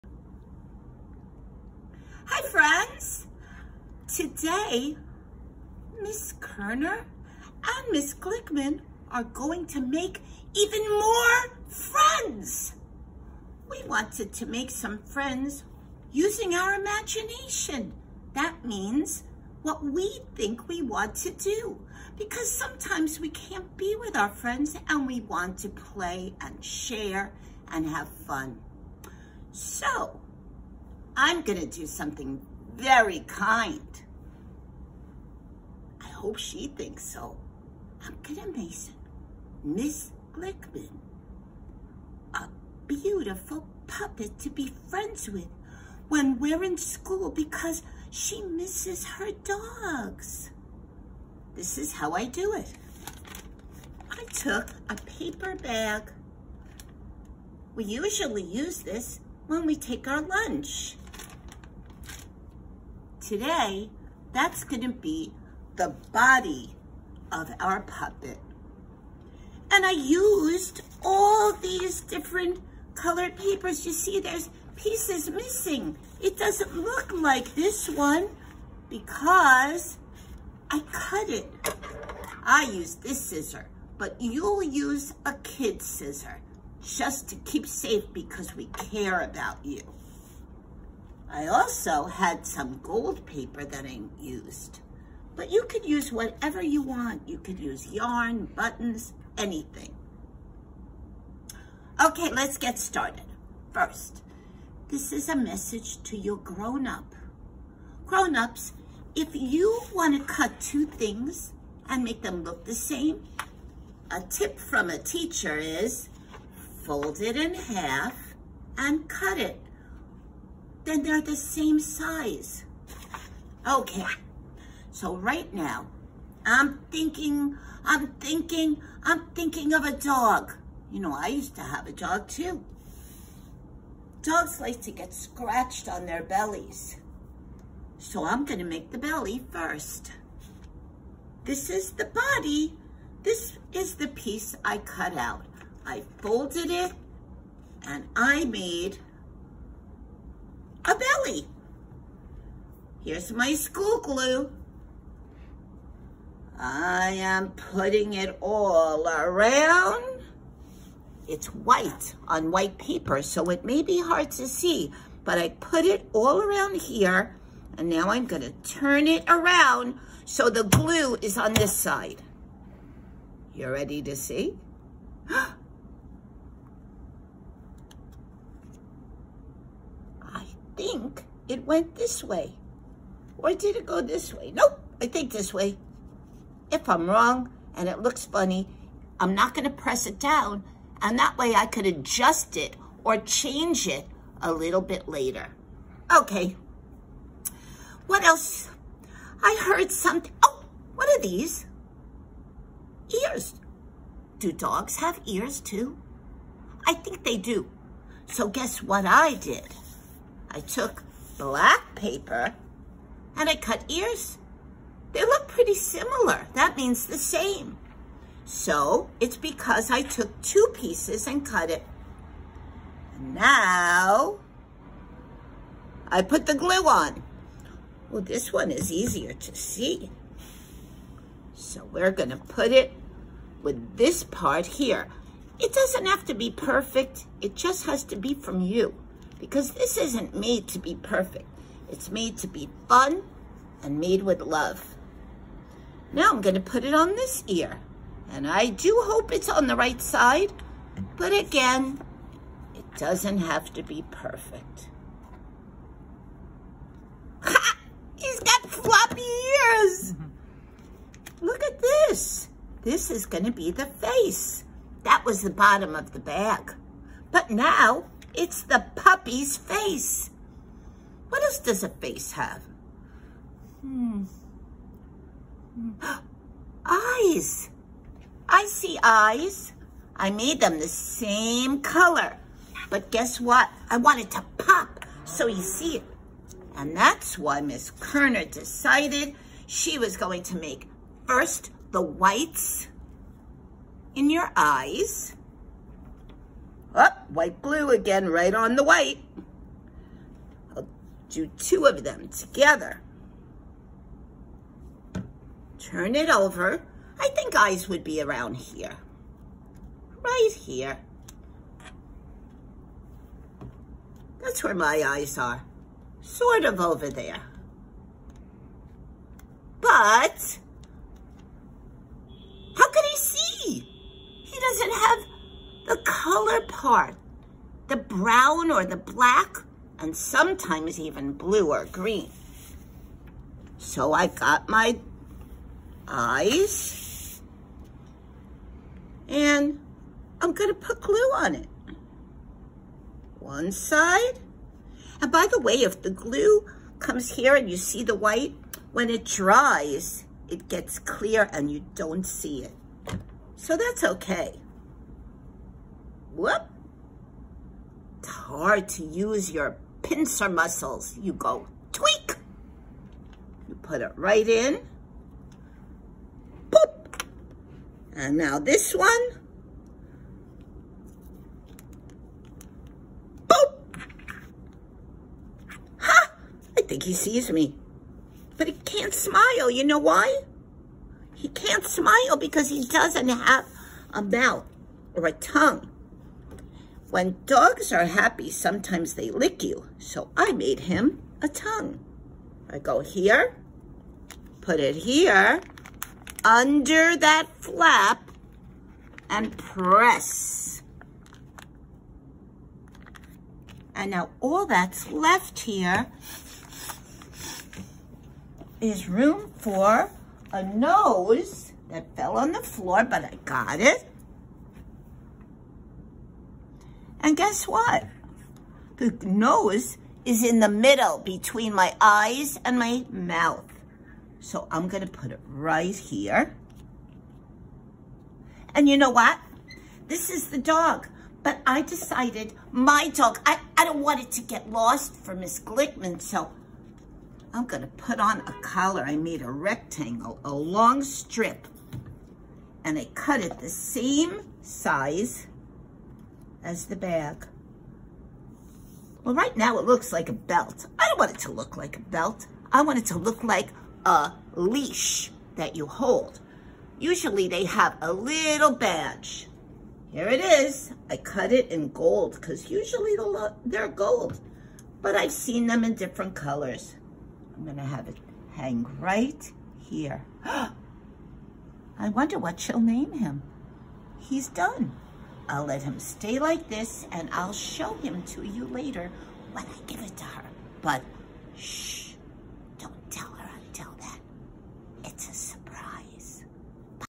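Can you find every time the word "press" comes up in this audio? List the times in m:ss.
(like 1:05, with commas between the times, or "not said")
3:09, 6:39.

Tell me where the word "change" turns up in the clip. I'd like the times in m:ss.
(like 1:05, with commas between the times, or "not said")
3:13.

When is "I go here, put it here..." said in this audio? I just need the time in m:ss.
6:32.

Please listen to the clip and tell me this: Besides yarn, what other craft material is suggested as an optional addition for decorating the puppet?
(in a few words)
buttons.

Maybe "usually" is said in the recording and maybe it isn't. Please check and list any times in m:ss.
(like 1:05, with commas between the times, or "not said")
0:57, 7:36, 7:42.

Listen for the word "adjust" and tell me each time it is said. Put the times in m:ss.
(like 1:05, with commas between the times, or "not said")
3:11.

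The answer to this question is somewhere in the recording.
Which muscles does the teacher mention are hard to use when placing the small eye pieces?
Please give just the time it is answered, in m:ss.
6:00.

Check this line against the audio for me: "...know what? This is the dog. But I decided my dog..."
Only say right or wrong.
right.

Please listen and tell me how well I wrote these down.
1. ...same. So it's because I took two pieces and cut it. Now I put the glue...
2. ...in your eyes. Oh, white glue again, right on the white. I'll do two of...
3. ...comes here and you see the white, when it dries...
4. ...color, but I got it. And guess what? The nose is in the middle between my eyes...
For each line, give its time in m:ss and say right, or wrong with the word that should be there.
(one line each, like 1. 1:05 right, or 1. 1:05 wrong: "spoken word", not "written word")
1. 3:37 right
2. 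4:54 right
3. 5:46 right
4. 6:52 wrong: "floor", not "color".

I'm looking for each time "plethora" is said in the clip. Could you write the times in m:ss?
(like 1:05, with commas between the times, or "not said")
not said.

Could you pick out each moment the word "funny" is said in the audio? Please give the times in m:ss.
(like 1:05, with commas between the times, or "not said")
3:08.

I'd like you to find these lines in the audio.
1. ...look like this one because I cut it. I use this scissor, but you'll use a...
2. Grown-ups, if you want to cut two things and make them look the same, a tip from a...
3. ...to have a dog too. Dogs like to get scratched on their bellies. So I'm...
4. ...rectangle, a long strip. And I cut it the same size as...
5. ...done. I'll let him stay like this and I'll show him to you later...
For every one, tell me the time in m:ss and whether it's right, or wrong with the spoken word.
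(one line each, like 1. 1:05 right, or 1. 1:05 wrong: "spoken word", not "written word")
1. 1:16 right
2. 1:48 right
3. 2:11 right
4. 7:19 right
5. 7:54 right.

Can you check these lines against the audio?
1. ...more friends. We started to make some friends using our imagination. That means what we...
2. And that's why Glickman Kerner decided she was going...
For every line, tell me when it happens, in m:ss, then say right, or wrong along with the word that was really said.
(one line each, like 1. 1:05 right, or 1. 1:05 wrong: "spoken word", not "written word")
1. 0:10 wrong: "wanted", not "started"
2. 4:46 wrong: "Miss", not "Glickman".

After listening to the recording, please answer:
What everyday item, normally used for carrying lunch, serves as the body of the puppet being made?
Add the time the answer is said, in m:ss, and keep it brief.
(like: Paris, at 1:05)
paper bag, at 0:54.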